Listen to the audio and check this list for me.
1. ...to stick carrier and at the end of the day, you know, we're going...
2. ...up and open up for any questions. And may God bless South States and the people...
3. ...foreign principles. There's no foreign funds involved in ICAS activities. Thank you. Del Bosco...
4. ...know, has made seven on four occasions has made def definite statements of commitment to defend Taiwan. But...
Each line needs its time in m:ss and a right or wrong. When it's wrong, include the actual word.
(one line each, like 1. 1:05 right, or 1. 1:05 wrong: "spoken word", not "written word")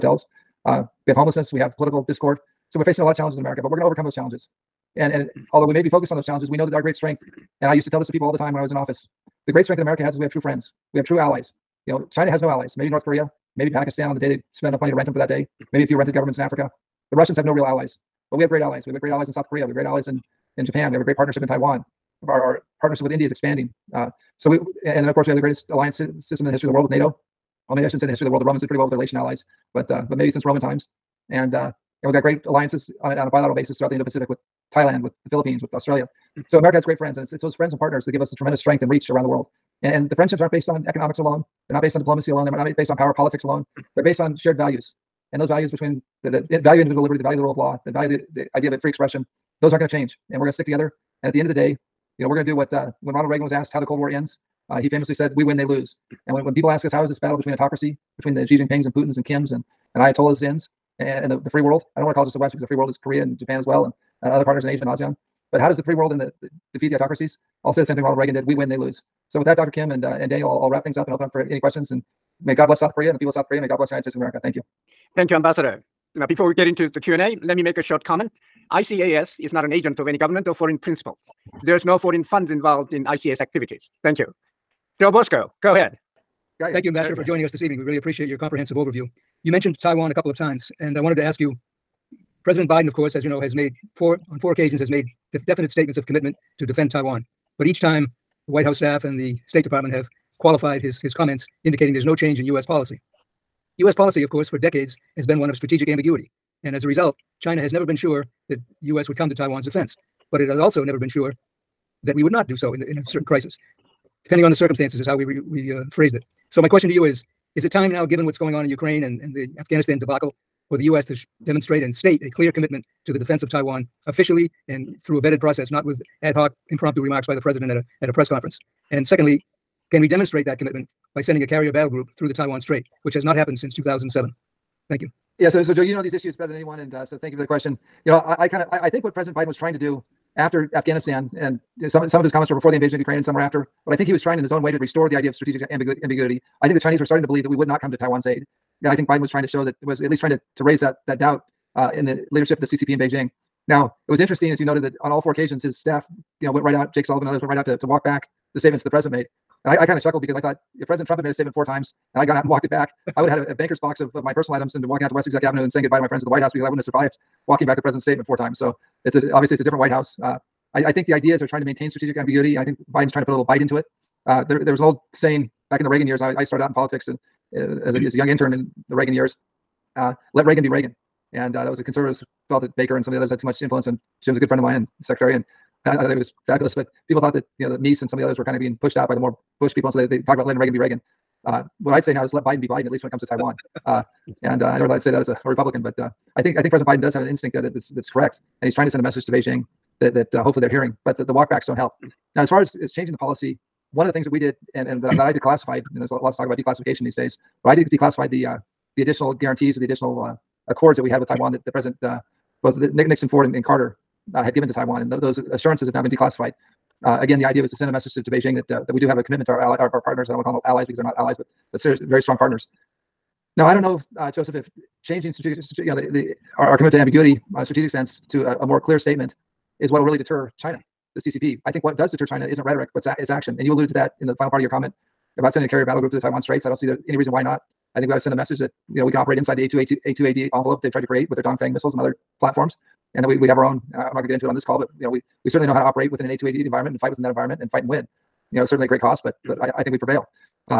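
1. 0:50 wrong: "together", not "carrier"
2. 1:10 wrong: "Korea", not "States"
3. 1:20 right
4. 1:33 wrong: "four", not "seven".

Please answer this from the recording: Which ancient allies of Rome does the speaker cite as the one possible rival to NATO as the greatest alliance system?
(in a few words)
Latian allies.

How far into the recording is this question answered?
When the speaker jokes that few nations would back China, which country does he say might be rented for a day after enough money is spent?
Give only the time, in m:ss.
0:13.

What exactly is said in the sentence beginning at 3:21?
But the the walkbacks don't help.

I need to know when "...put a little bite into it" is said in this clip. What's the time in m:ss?
2:53.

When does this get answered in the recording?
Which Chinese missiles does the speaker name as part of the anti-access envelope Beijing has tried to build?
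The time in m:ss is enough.
4:01.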